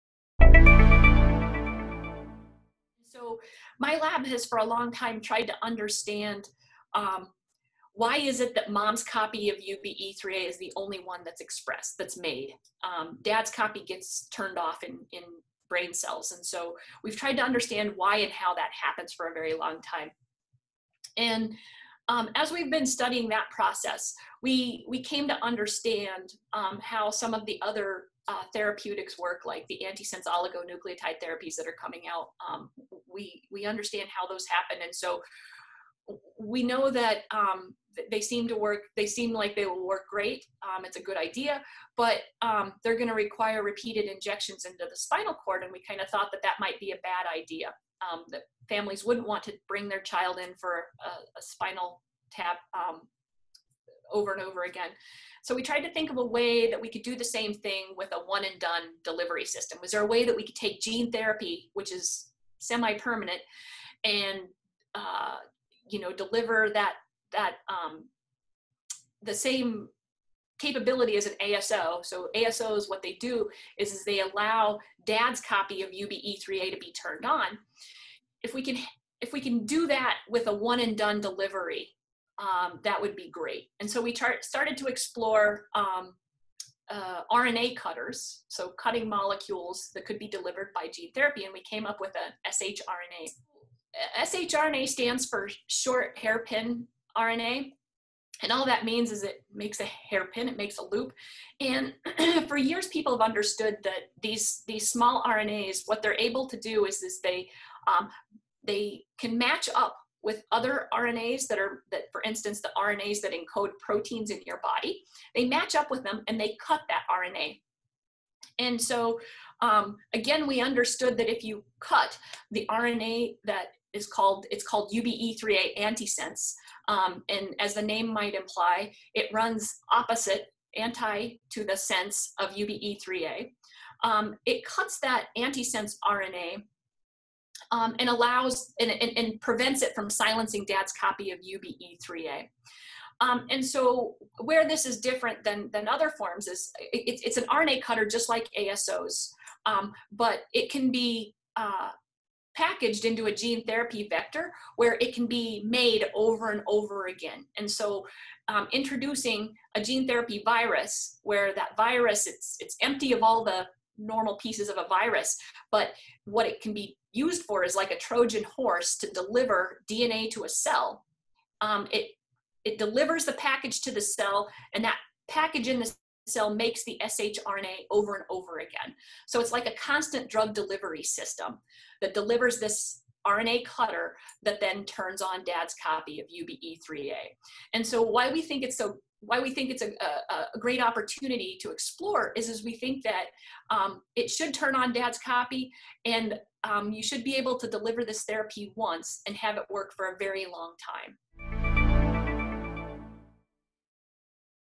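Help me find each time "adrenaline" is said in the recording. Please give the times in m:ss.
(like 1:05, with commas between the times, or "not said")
not said.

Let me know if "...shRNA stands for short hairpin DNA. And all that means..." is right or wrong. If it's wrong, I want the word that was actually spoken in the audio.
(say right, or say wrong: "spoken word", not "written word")
wrong: "RNA", not "DNA".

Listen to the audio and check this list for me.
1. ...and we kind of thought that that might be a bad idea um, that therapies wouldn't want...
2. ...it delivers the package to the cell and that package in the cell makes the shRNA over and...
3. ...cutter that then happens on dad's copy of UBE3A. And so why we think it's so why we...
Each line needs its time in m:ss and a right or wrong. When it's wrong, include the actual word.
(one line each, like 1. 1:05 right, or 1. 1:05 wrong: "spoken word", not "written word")
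1. 0:45 wrong: "families", not "therapies"
2. 2:52 right
3. 3:03 wrong: "turns", not "happens".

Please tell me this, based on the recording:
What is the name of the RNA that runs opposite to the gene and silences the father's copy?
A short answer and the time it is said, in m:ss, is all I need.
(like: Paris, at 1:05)
UBE3A antisense, at 2:04.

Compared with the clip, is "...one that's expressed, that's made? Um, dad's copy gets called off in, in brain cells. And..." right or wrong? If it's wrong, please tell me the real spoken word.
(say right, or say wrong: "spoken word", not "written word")
wrong: "turned", not "called".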